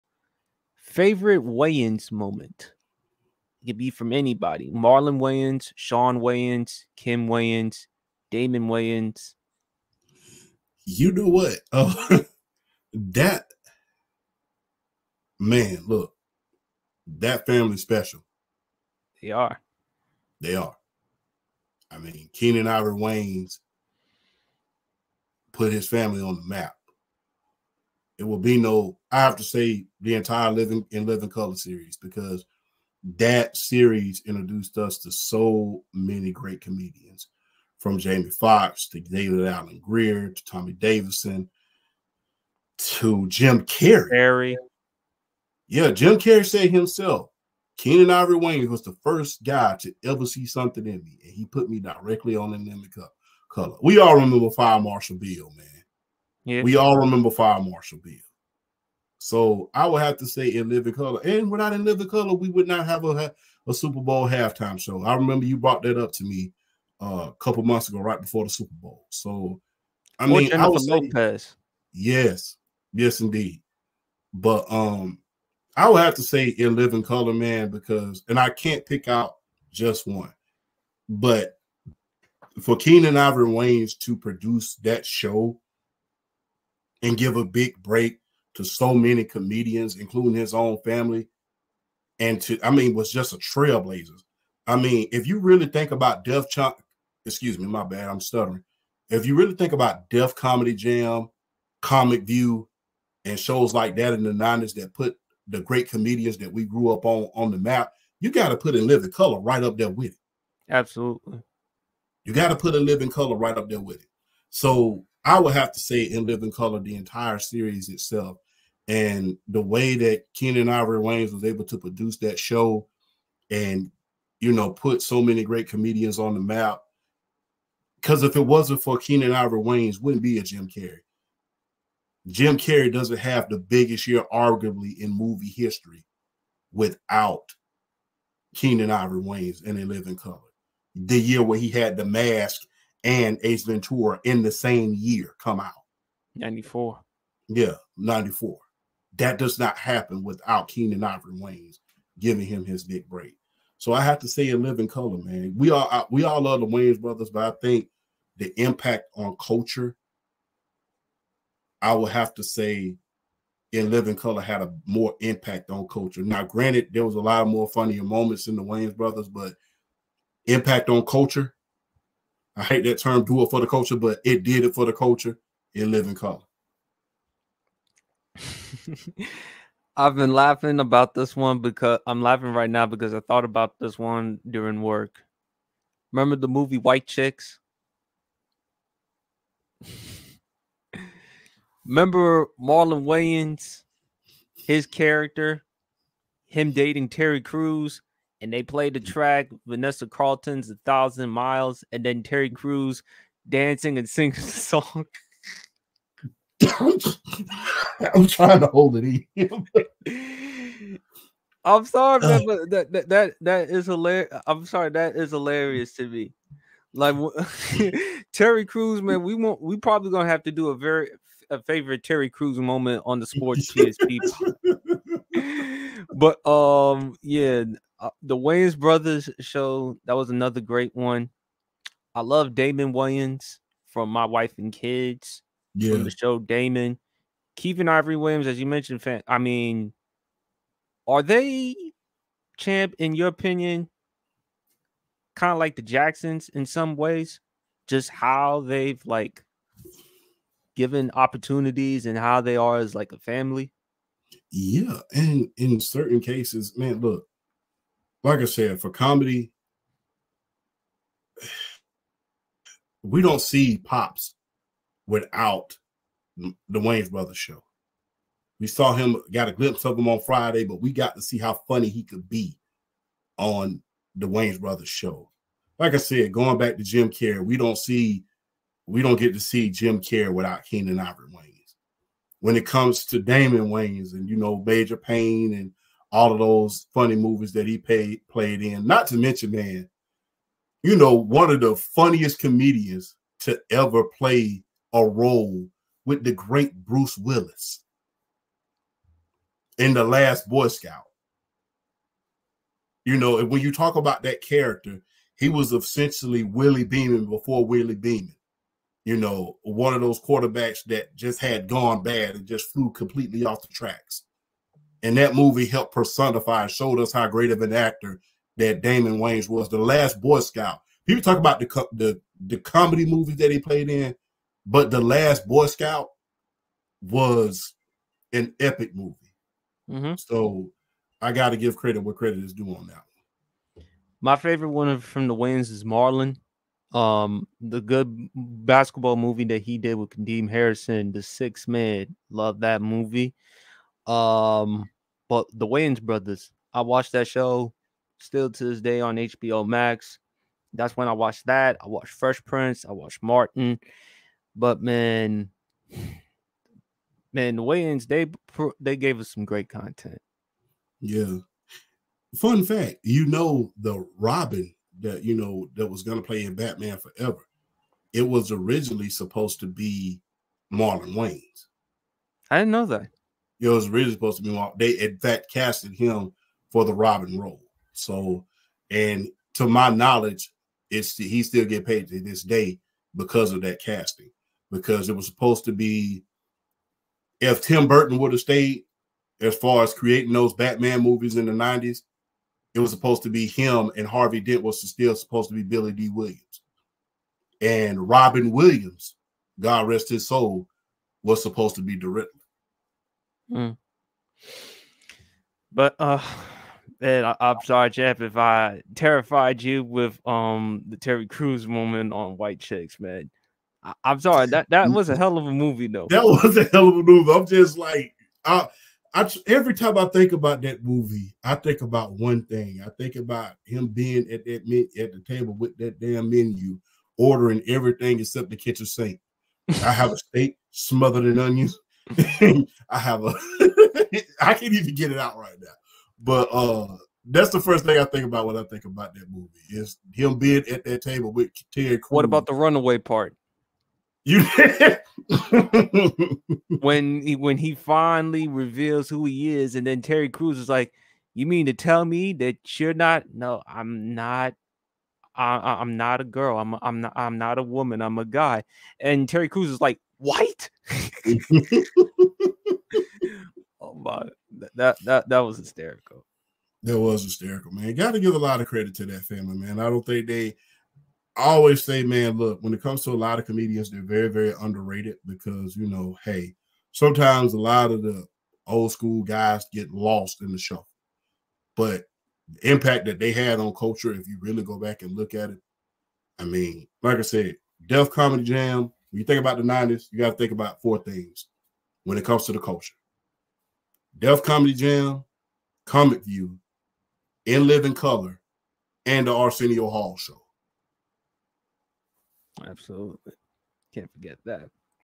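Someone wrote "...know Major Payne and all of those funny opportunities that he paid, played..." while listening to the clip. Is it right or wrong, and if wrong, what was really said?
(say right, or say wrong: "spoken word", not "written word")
wrong: "movies", not "opportunities".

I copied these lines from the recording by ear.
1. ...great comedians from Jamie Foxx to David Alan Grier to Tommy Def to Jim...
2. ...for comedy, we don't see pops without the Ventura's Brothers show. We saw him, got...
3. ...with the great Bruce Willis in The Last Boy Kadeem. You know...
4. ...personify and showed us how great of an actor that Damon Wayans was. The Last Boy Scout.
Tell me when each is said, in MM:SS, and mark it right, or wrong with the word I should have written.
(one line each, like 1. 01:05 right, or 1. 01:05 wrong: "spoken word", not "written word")
1. 00:36 wrong: "Davidson", not "Def"
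2. 04:18 wrong: "Wayne", not "Ventura"
3. 04:56 wrong: "Scout", not "Kadeem"
4. 05:15 right.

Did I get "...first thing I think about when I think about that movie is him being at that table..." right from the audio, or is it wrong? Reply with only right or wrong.
right.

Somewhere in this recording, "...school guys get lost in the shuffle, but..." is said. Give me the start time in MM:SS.
07:58.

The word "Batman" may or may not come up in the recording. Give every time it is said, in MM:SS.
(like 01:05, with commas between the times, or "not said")
06:06, 06:30.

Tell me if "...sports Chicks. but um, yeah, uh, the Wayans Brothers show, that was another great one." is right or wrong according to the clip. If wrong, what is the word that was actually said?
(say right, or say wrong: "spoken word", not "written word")
wrong: "PSP", not "Chicks".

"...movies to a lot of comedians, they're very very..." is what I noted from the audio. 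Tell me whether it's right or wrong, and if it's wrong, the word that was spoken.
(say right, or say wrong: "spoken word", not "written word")
wrong: "comes", not "movies".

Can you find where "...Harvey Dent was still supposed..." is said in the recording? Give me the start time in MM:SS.
06:34.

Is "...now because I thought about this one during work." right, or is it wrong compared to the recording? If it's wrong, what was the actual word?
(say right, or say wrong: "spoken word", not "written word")
right.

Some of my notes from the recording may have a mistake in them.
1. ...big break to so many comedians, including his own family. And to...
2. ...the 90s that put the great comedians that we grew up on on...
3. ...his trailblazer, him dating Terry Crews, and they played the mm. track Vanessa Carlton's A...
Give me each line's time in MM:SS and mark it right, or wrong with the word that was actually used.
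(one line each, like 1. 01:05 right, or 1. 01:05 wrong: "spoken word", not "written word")
1. 01:27 right
2. 01:44 right
3. 03:14 wrong: "character", not "trailblazer".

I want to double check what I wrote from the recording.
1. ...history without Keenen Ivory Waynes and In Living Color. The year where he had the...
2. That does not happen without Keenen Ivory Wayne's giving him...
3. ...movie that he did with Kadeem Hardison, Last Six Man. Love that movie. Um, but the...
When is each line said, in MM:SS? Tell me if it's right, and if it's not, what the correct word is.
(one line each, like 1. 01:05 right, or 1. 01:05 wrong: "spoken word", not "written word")
1. 02:15 right
2. 02:29 right
3. 05:39 wrong: "The", not "Last".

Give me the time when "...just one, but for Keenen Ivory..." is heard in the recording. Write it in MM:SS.
01:19.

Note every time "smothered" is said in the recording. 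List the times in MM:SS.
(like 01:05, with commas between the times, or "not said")
07:10.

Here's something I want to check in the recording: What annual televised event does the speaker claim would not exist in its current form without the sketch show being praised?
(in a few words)
Super Bowl halftime show.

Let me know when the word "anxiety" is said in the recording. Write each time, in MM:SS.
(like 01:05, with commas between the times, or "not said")
not said.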